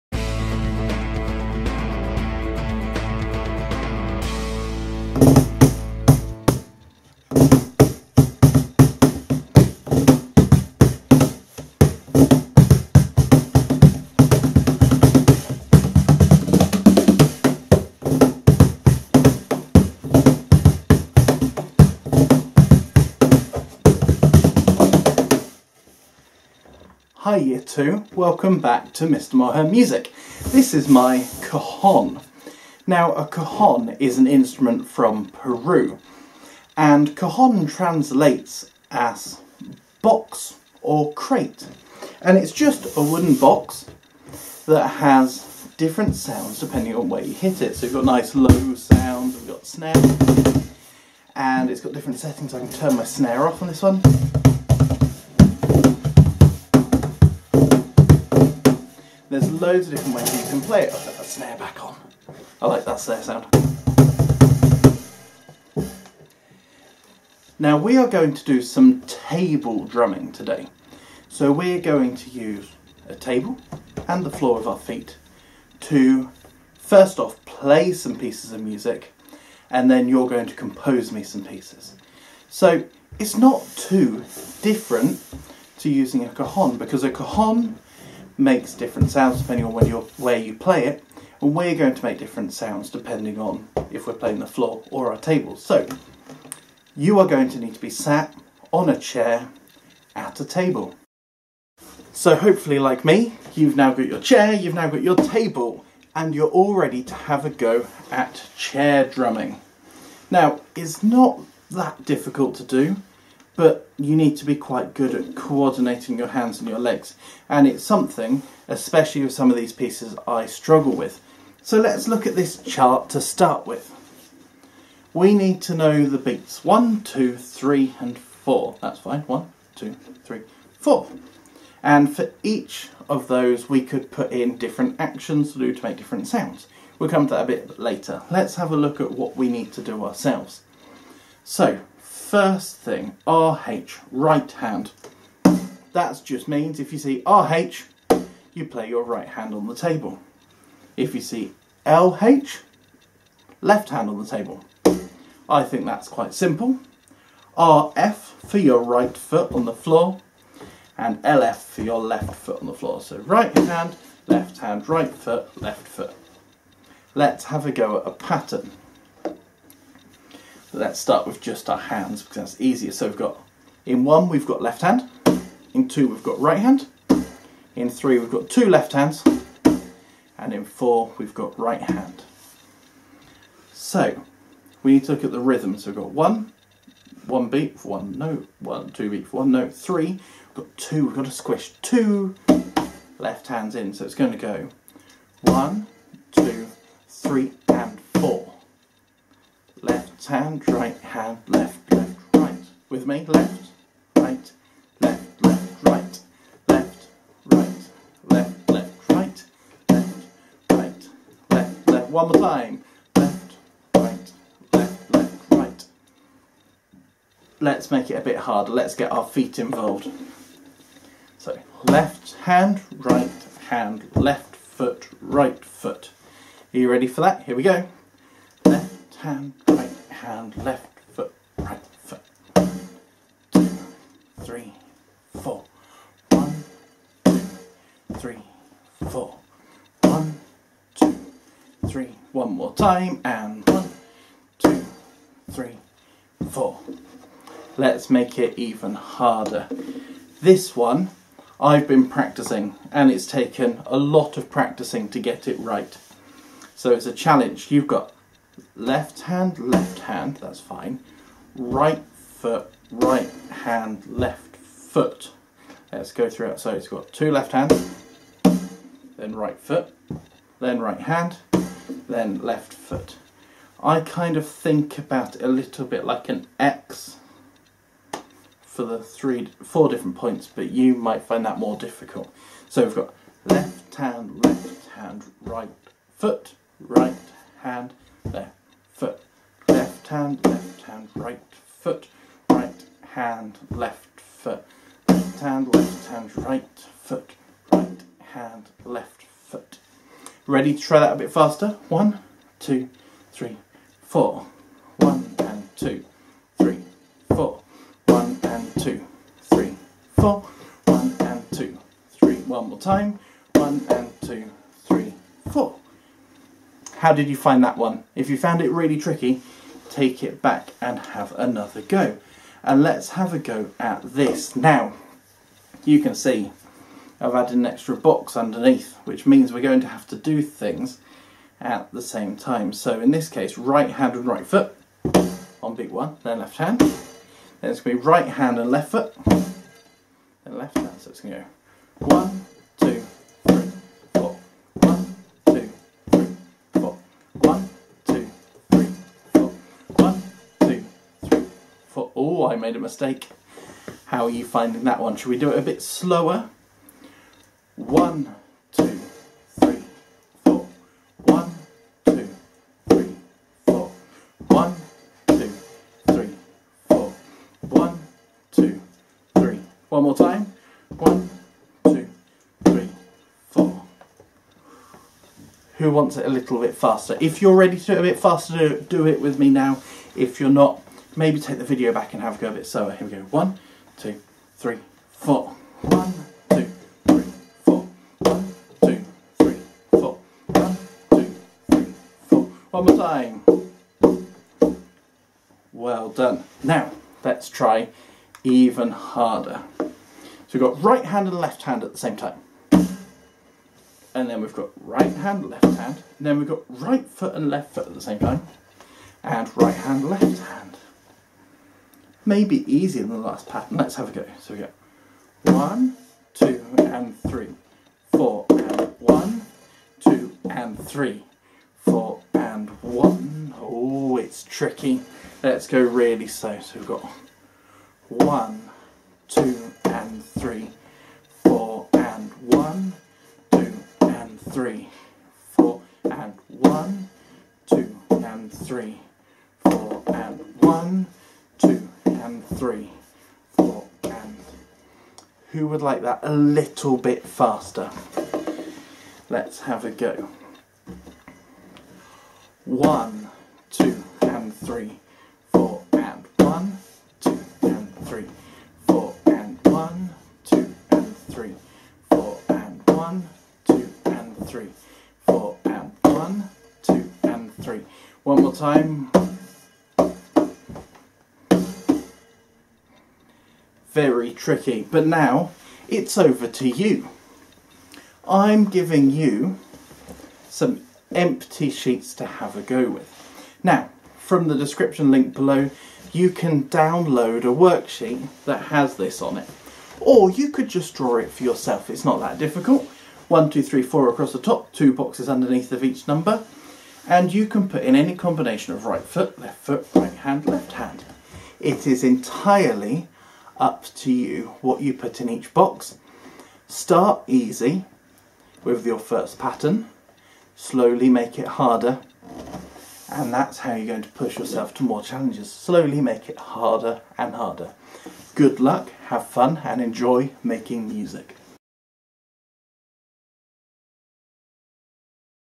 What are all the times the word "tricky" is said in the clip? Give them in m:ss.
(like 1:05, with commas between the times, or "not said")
5:18, 7:04, 7:54.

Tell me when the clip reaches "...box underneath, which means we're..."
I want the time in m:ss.
5:27.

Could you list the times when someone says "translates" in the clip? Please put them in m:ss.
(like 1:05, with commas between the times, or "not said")
0:37.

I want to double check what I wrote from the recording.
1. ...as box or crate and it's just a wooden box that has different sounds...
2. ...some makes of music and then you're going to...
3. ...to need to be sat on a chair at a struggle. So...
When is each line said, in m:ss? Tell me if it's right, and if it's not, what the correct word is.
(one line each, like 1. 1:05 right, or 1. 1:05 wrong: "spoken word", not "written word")
1. 0:38 right
2. 1:17 wrong: "pieces", not "makes"
3. 1:37 wrong: "table", not "struggle".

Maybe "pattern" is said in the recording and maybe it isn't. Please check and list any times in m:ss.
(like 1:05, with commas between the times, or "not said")
2:48, 6:53, 8:29.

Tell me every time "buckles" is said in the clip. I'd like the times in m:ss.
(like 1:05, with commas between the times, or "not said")
not said.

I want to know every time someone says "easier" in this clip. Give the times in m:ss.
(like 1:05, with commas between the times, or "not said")
2:52, 6:52.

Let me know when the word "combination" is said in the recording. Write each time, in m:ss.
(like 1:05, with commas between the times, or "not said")
8:18.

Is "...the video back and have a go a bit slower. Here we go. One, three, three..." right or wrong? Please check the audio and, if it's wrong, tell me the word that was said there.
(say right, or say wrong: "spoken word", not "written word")
wrong: "two", not "three".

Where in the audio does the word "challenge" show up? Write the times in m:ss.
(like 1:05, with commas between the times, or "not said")
4:17, 8:35.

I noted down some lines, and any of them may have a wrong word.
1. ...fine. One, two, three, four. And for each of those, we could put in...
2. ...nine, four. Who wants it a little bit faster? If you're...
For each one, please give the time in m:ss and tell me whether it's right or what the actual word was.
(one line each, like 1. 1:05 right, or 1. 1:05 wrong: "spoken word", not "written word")
1. 2:08 right
2. 6:12 wrong: "three", not "nine".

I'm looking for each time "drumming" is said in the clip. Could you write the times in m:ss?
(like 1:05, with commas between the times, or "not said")
1:09, 1:49.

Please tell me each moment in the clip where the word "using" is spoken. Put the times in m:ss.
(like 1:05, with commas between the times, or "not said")
1:25.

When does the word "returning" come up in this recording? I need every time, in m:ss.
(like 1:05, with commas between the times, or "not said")
not said.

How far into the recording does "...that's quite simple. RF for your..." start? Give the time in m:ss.
2:35.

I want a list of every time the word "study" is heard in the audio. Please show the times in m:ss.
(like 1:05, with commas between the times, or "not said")
not said.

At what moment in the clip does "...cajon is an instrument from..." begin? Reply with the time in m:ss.
0:33.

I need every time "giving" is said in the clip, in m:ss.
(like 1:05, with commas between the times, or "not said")
7:58.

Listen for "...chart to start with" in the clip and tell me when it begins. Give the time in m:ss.
2:02.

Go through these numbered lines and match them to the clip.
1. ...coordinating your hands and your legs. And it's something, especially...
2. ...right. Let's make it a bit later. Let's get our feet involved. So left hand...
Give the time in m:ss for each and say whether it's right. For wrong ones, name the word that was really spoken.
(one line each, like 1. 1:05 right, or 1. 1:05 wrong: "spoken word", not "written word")
1. 1:55 right
2. 3:35 wrong: "harder", not "later".